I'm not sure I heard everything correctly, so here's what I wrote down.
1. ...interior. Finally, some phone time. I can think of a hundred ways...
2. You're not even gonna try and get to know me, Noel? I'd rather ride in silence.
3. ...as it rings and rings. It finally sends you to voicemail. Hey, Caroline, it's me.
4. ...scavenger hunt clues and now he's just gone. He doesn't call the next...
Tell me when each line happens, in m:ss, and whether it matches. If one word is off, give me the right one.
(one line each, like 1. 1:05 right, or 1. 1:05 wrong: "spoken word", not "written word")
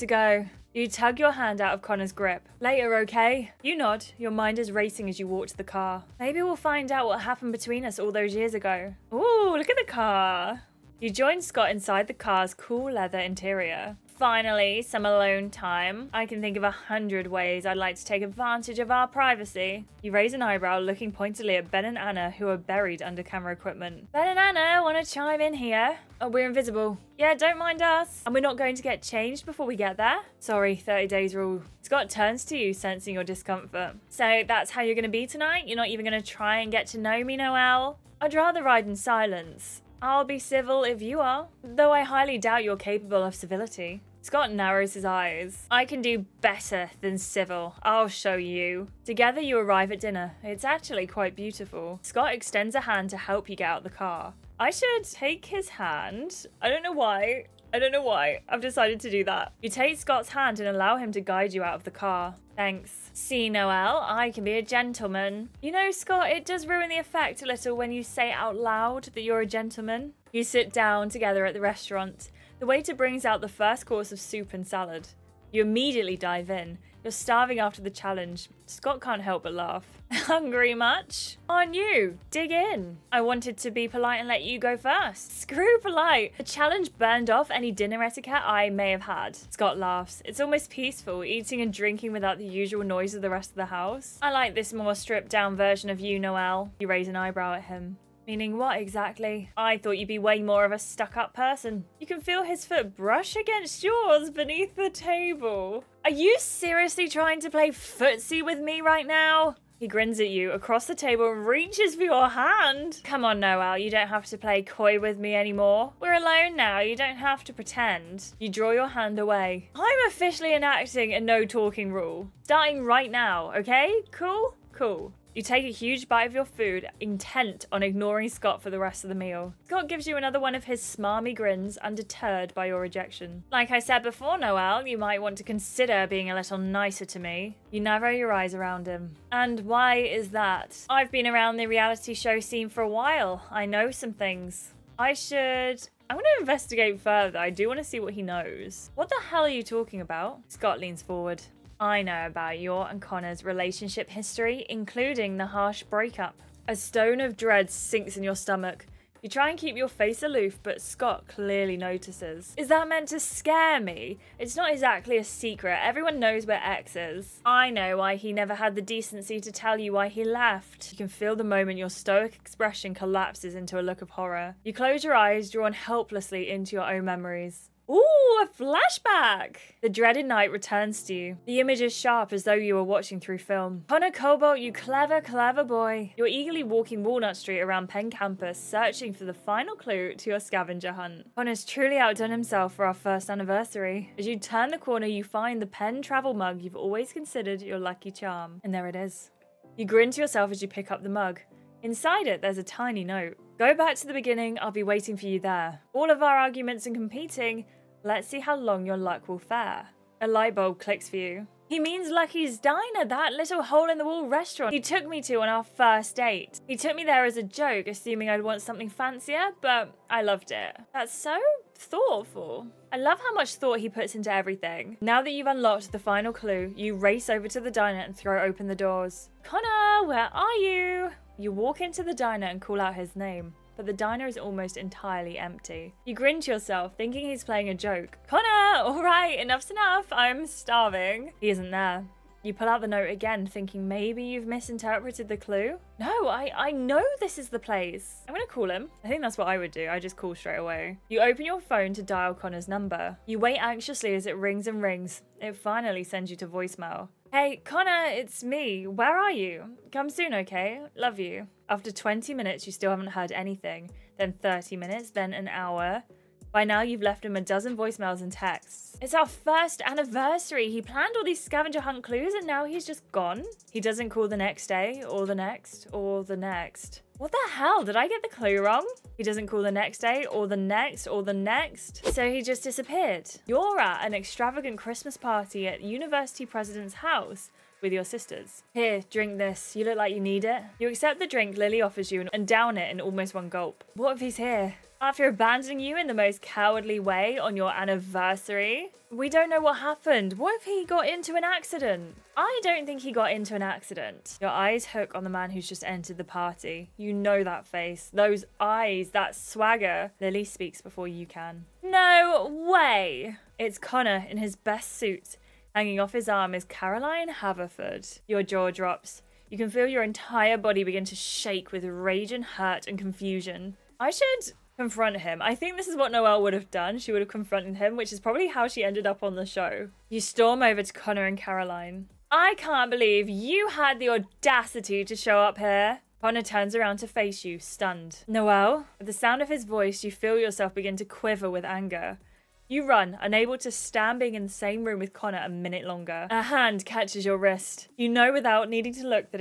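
1. 0:13 wrong: "alone", not "phone"
2. 0:35 right
3. 4:14 wrong: "Connor", not "Caroline"
4. 4:31 right.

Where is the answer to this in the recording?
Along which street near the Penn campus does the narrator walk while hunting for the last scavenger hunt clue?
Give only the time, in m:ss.
3:07.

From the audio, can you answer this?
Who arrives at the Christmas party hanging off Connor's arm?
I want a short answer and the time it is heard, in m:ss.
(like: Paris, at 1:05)
Caroline Haverford, at 5:16.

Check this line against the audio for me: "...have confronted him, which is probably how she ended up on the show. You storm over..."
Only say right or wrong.
right.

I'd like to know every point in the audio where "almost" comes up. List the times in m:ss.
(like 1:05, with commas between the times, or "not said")
1:30, 3:54, 4:52.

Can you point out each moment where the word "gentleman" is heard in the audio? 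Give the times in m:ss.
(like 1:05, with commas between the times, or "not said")
1:04, 1:09.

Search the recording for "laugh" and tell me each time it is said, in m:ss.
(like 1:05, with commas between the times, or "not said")
1:19, 1:29.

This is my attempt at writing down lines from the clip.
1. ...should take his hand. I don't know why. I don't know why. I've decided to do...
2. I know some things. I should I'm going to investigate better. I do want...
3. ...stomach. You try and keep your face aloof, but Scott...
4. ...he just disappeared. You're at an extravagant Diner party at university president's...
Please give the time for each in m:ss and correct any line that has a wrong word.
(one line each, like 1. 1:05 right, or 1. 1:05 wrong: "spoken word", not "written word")
1. 0:54 right
2. 2:23 wrong: "further", not "better"
3. 2:38 right
4. 4:42 wrong: "Christmas", not "Diner".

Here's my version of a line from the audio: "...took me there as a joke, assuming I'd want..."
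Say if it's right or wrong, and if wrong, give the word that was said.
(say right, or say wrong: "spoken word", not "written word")
right.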